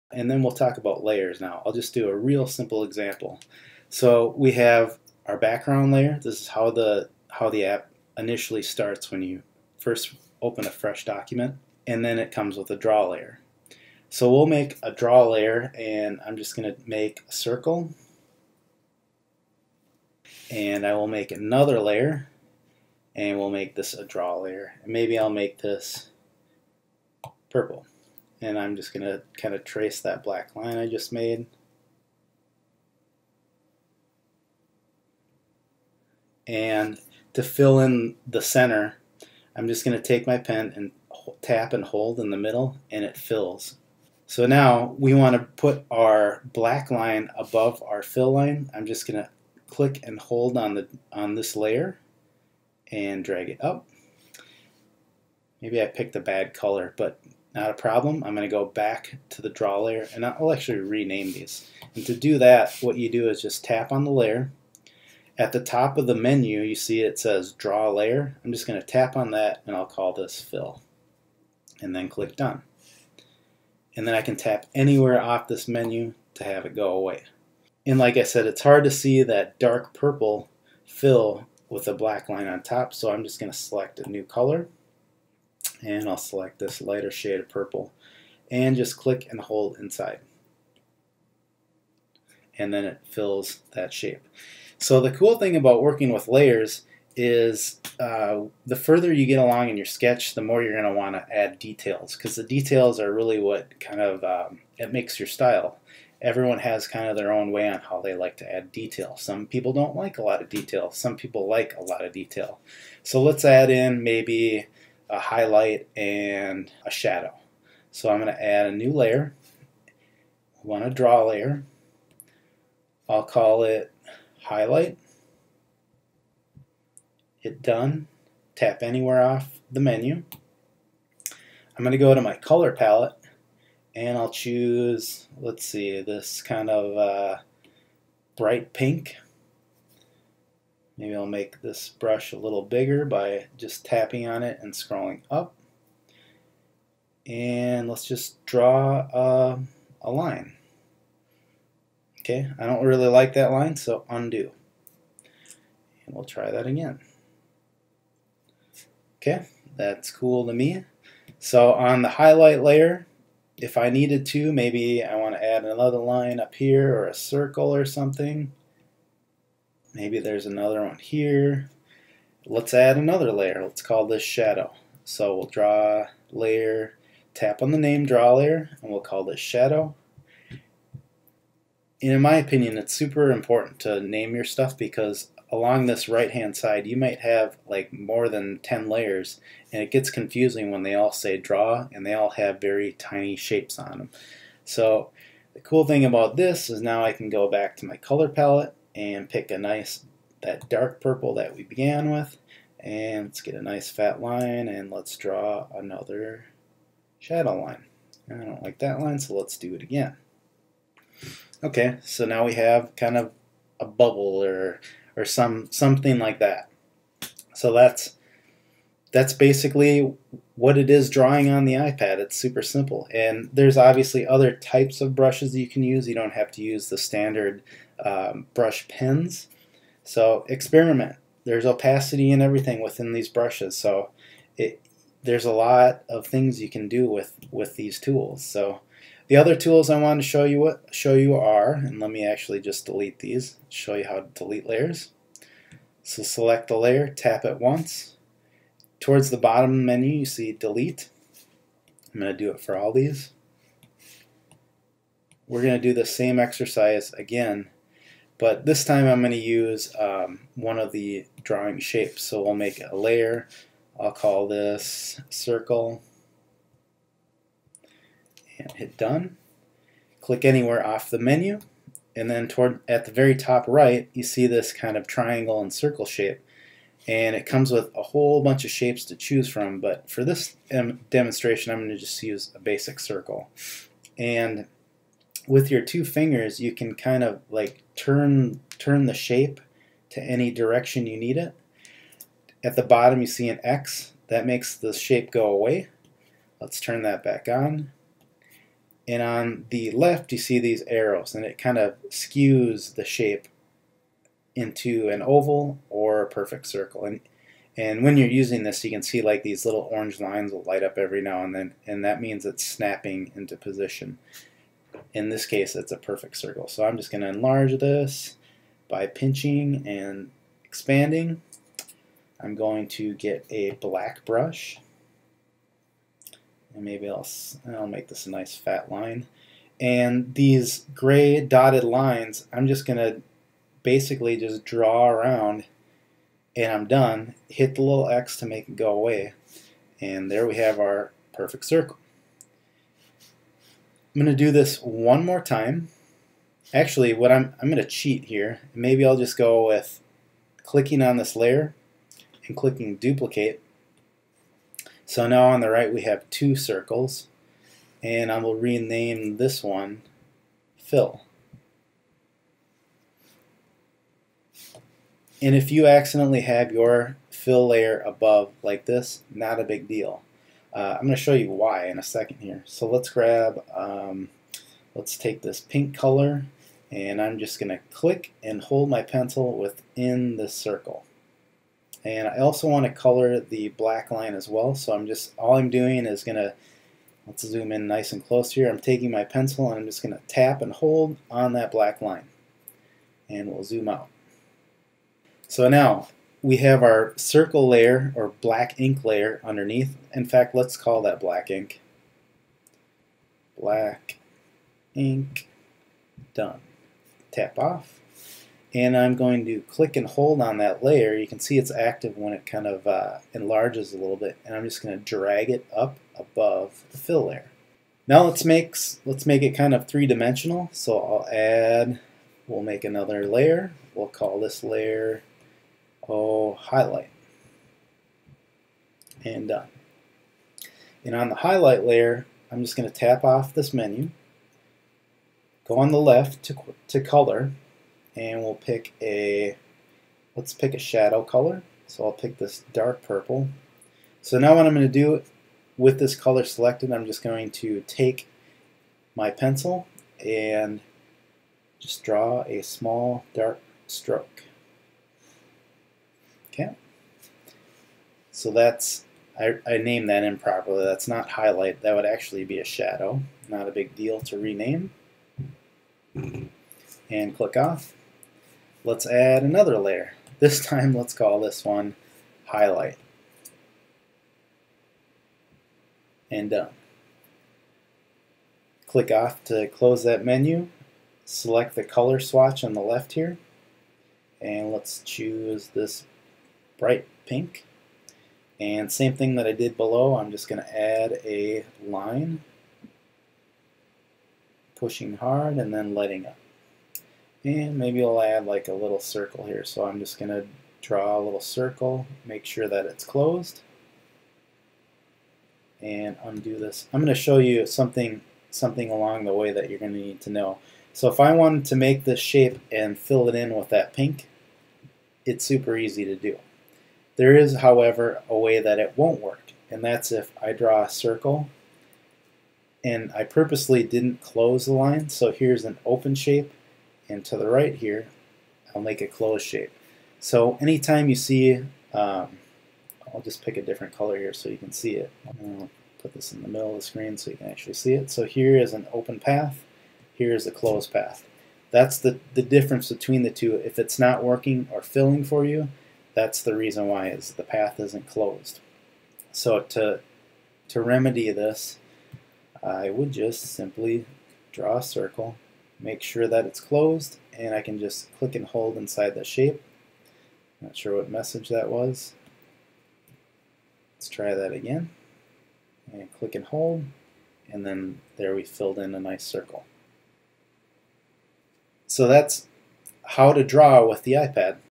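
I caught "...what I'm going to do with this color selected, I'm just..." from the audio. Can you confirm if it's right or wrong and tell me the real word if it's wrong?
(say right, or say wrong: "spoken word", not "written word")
right.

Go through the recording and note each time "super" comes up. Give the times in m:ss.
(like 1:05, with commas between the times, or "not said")
3:02, 3:42, 8:35.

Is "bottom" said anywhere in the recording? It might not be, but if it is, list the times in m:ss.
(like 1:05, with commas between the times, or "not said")
4:09, 4:52.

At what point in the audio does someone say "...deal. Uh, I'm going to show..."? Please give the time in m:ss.
6:09.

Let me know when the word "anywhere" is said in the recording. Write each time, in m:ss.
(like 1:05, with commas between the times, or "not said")
1:14, 2:08, 4:30.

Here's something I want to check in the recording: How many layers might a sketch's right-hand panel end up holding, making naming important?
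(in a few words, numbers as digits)
10.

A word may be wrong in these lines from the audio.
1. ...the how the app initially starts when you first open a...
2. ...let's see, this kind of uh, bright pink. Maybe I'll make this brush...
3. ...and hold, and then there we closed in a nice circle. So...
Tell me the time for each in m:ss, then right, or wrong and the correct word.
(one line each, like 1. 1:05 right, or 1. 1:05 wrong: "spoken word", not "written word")
1. 0:06 right
2. 2:15 right
3. 9:26 wrong: "filled", not "closed".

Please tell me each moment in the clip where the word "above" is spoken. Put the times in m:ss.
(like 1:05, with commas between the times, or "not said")
0:47, 6:08, 6:56.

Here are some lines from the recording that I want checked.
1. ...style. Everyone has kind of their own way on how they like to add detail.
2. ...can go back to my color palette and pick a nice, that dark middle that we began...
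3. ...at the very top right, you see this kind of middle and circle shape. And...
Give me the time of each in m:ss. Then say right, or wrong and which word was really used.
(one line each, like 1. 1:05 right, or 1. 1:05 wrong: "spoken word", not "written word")
1. 1:45 right
2. 3:17 wrong: "purple", not "middle"
3. 4:32 wrong: "triangle", not "middle".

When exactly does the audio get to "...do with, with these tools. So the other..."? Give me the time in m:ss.
3:56.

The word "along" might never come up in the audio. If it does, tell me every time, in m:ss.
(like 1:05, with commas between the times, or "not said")
1:39, 3:05, 8:28.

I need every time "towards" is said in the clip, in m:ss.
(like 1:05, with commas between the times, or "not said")
4:08, 4:32.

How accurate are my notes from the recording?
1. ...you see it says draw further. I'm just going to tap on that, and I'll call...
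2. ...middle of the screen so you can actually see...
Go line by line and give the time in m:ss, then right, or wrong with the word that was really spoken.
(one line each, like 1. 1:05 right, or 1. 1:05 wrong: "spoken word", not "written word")
1. 1:06 wrong: "layer", not "further"
2. 8:56 right.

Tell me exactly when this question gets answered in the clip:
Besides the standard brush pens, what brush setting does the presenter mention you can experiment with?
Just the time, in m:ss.
3:51.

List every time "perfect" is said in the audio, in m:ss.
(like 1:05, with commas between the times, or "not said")
5:06, 5:15, 5:41.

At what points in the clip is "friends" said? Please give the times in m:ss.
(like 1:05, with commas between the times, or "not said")
not said.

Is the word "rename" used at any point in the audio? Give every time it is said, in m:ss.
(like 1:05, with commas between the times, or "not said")
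1:00, 5:58, 7:44.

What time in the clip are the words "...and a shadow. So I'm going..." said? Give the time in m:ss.
1:55.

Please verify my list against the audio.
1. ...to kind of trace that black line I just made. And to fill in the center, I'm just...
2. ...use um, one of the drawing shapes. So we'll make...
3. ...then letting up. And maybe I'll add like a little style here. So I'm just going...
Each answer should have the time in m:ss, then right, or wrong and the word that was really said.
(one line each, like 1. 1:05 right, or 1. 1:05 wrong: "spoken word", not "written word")
1. 0:29 right
2. 4:19 right
3. 8:15 wrong: "circle", not "style".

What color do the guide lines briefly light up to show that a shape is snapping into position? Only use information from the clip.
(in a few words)
orange.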